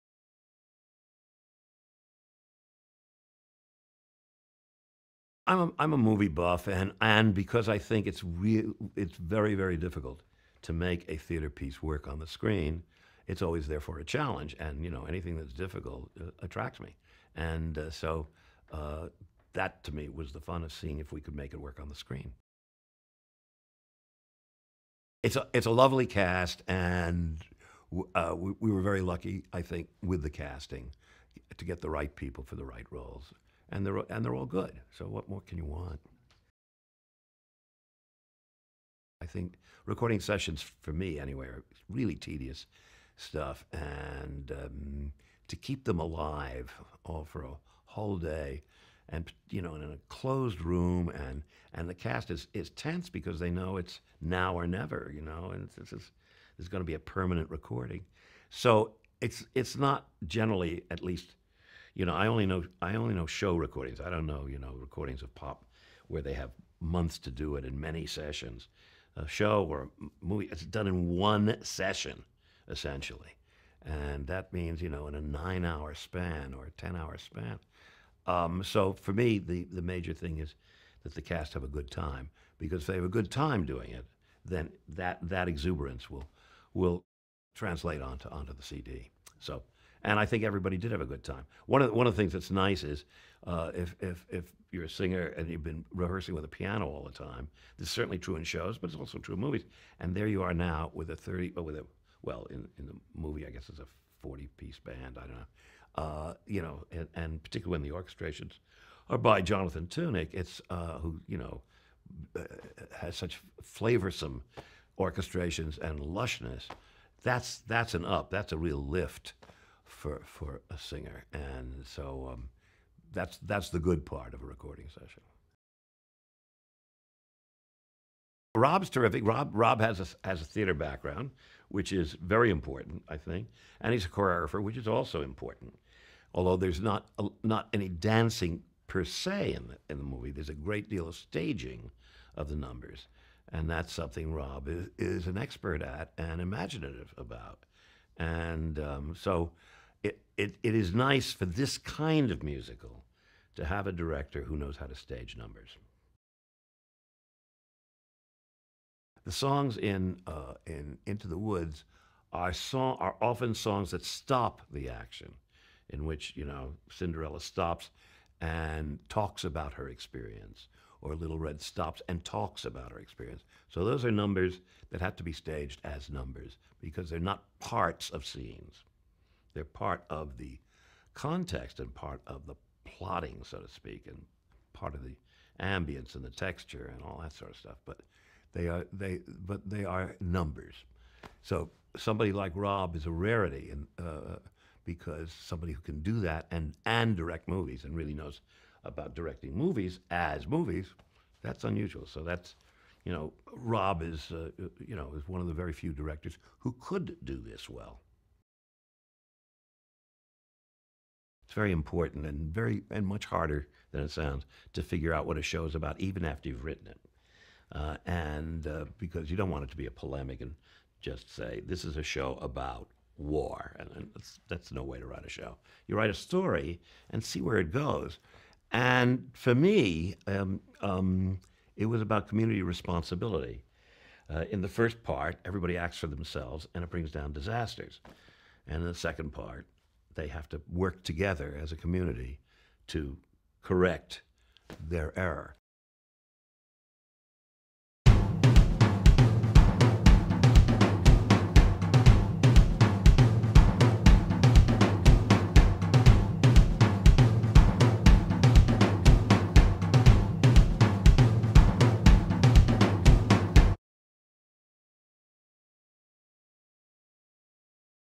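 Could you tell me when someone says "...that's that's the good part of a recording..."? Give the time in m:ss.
2:03.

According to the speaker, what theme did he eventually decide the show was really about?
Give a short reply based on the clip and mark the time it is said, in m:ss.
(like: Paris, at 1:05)
community responsibility, at 3:52.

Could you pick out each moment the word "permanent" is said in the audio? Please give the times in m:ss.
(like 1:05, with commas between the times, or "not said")
0:56.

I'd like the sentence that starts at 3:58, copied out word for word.
And in the second part, they have to work together as a community to correct their error.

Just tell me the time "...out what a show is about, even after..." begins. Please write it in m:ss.
3:35.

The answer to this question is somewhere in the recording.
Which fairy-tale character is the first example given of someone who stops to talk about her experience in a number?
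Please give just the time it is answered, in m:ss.
2:46.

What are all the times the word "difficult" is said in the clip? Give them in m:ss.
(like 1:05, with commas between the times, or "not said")
0:09, 0:15.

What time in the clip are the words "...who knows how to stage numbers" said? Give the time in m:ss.
2:34.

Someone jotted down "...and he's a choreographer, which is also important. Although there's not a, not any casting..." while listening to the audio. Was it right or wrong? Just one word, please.
wrong.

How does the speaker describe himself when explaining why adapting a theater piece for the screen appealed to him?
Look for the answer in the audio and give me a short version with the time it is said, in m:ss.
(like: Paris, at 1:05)
movie buff, at 0:05.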